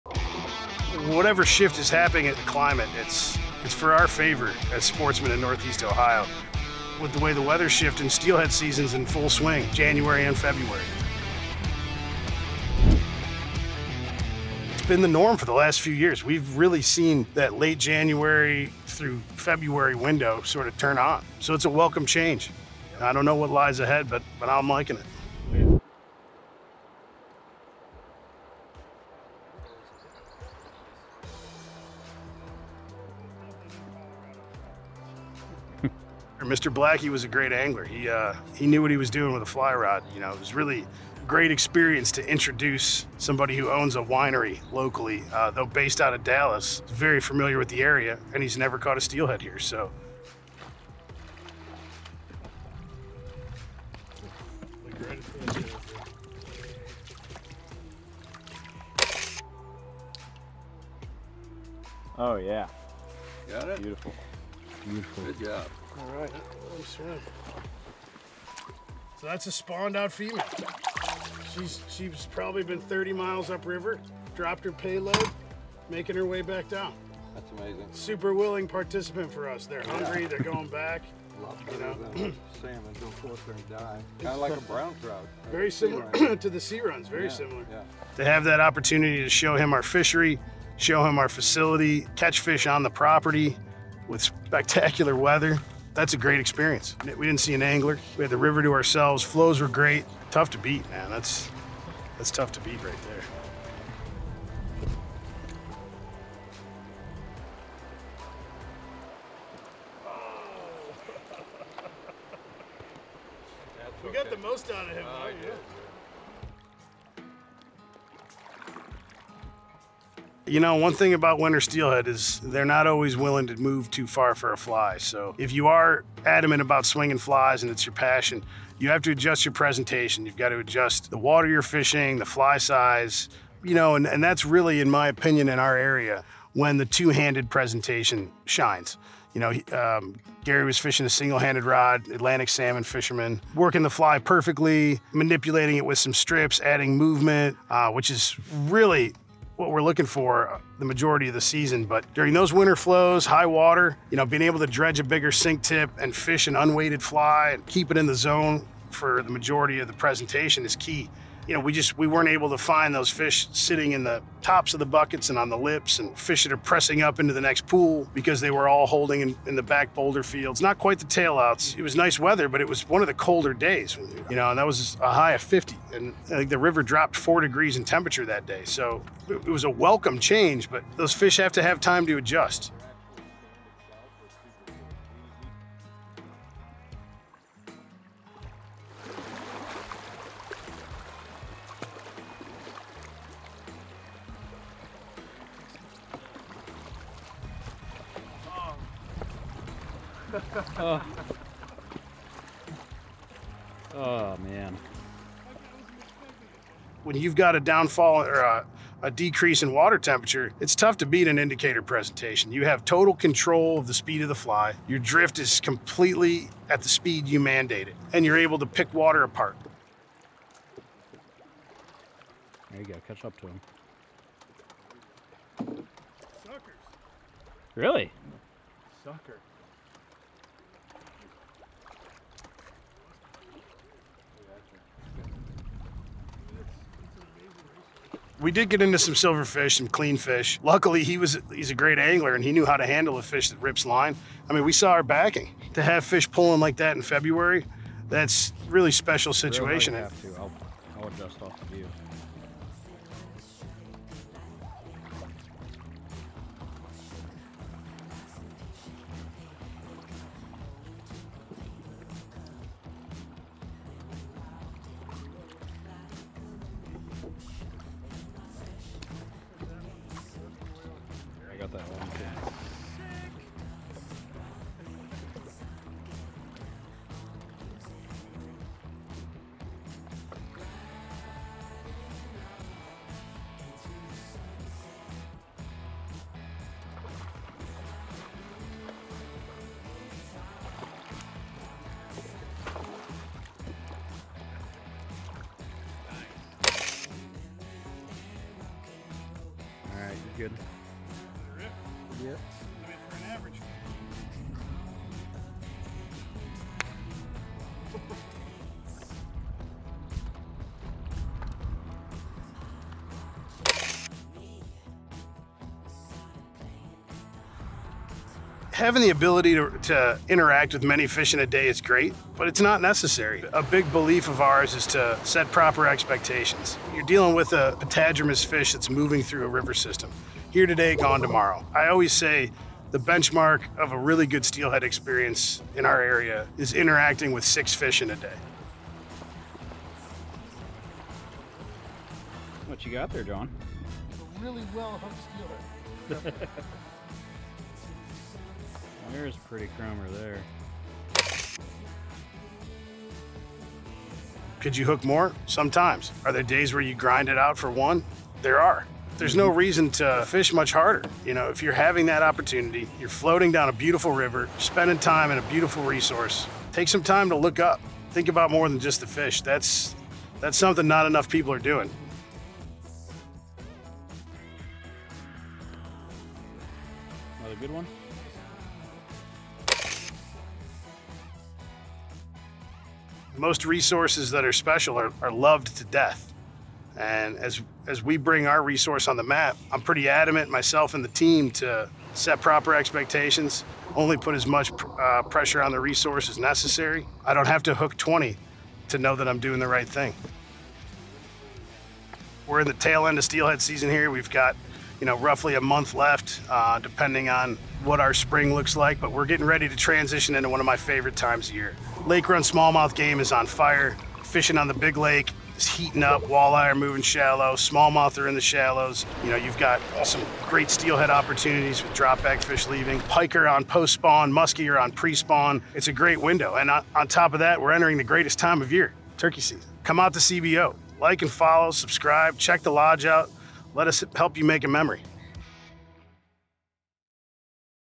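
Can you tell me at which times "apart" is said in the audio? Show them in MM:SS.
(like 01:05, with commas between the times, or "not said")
03:39.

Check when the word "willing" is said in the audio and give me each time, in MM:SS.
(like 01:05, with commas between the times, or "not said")
01:18, 02:03.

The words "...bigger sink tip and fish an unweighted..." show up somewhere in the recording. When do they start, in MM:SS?
02:35.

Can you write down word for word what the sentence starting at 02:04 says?
So if you are adamant about swinging flies and it's your passion, you have to adjust your presentation.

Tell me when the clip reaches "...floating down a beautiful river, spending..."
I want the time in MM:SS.
06:03.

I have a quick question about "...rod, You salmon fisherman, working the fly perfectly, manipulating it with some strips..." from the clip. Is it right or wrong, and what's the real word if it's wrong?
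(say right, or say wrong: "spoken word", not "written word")
wrong: "Atlantic", not "You".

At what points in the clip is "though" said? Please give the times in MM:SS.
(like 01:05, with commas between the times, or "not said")
00:45.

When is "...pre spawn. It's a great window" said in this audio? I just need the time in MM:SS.
07:04.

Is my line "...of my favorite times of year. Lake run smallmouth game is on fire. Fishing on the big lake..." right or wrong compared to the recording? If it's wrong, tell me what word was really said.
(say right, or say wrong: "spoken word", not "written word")
right.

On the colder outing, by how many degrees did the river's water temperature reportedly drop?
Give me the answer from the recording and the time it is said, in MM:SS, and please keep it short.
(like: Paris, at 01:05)
4 degrees, at 02:57.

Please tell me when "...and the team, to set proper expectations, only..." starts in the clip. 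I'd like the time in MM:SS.
06:30.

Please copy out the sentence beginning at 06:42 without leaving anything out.
We're in the tail end of steelhead season here.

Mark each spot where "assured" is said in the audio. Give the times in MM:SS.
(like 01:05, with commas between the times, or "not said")
not said.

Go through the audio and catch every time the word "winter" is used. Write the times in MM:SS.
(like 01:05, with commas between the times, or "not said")
02:01, 02:32.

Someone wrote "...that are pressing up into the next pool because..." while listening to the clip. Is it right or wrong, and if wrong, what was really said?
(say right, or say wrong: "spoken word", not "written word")
right.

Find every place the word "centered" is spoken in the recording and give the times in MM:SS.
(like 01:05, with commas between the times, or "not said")
not said.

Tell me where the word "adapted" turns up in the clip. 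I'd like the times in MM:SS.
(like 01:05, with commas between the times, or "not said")
not said.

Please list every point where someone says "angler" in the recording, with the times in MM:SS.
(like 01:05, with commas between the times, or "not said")
00:37, 01:37, 04:01.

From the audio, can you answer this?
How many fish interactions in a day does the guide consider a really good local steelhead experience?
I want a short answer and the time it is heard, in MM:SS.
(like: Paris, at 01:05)
6, at 05:37.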